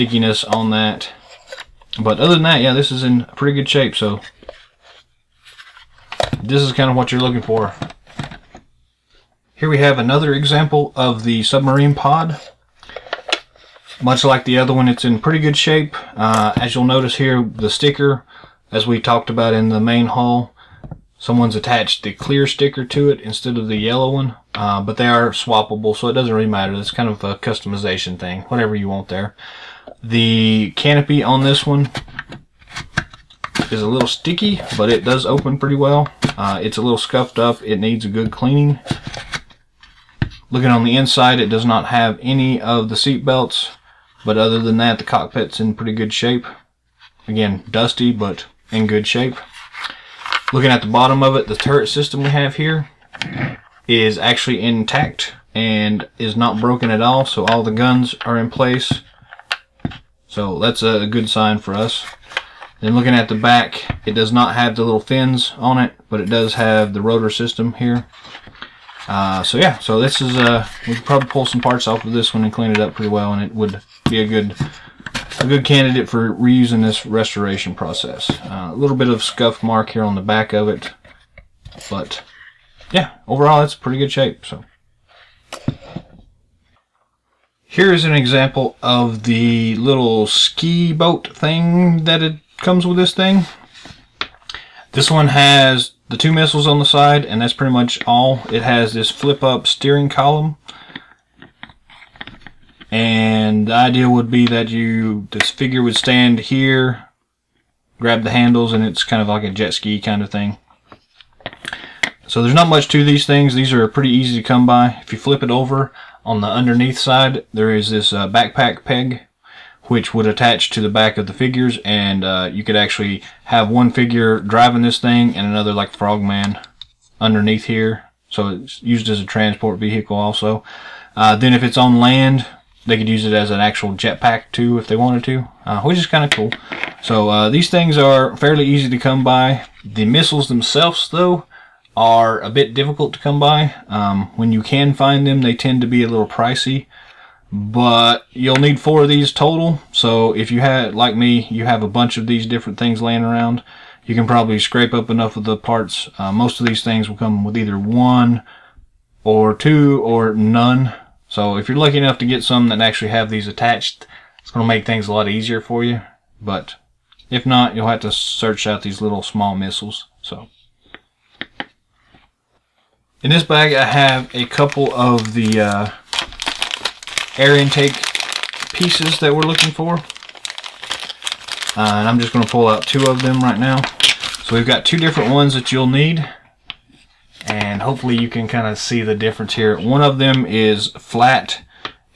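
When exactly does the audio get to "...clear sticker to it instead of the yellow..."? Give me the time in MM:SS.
00:22.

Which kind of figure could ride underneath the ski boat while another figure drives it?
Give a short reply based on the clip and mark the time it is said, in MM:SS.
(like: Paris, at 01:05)
Frogman, at 02:05.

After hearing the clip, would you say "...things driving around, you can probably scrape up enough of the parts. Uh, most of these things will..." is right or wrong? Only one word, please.
wrong.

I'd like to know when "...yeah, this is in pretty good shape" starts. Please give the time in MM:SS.
00:02.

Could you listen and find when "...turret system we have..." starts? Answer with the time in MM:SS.
00:51.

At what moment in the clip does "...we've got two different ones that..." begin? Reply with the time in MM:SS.
03:04.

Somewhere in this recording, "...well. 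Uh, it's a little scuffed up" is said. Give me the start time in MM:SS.
00:35.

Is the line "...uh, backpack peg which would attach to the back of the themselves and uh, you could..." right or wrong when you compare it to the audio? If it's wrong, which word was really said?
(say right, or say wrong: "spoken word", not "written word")
wrong: "figures", not "themselves".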